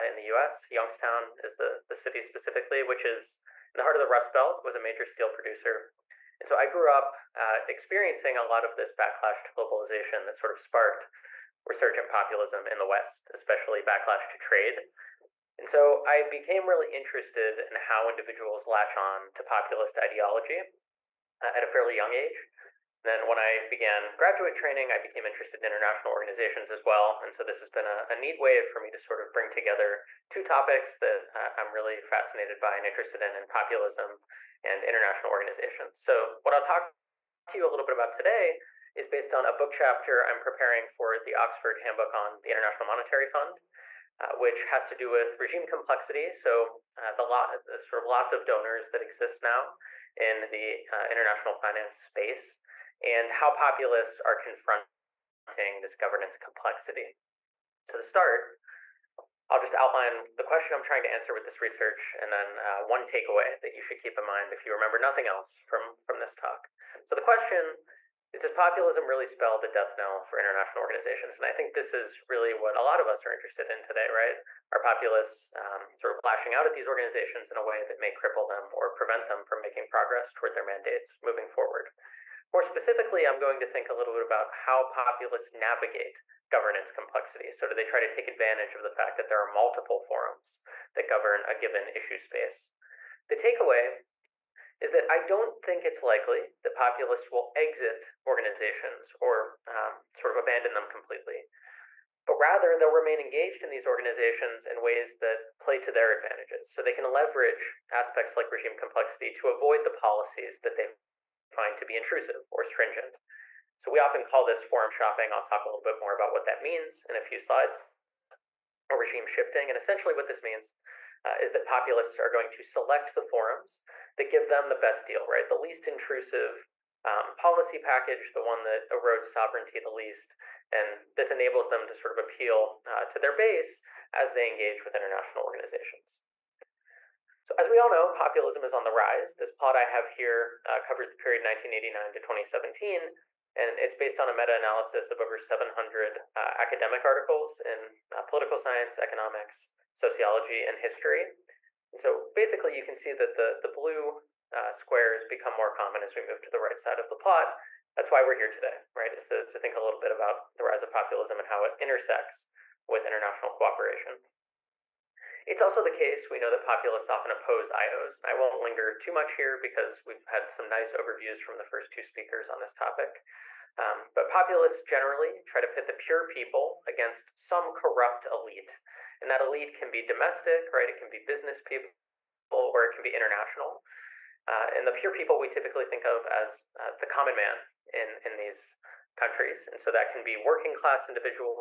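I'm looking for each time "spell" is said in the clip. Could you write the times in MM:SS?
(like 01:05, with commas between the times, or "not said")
01:09.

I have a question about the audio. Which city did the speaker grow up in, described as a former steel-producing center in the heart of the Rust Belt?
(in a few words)
Youngstown.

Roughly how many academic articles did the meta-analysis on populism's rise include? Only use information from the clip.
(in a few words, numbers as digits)
over 700.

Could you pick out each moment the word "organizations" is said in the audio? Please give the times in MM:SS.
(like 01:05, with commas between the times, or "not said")
00:26, 00:35, 01:10, 01:16, 01:38, 01:43, 02:15.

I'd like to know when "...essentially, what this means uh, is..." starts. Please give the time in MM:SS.
01:59.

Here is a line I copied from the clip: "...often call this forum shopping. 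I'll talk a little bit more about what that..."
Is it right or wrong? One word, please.
right.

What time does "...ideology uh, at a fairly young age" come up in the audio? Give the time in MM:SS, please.
00:19.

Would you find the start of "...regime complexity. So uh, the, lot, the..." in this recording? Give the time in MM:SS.
00:45.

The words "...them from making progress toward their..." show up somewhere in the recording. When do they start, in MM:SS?
01:19.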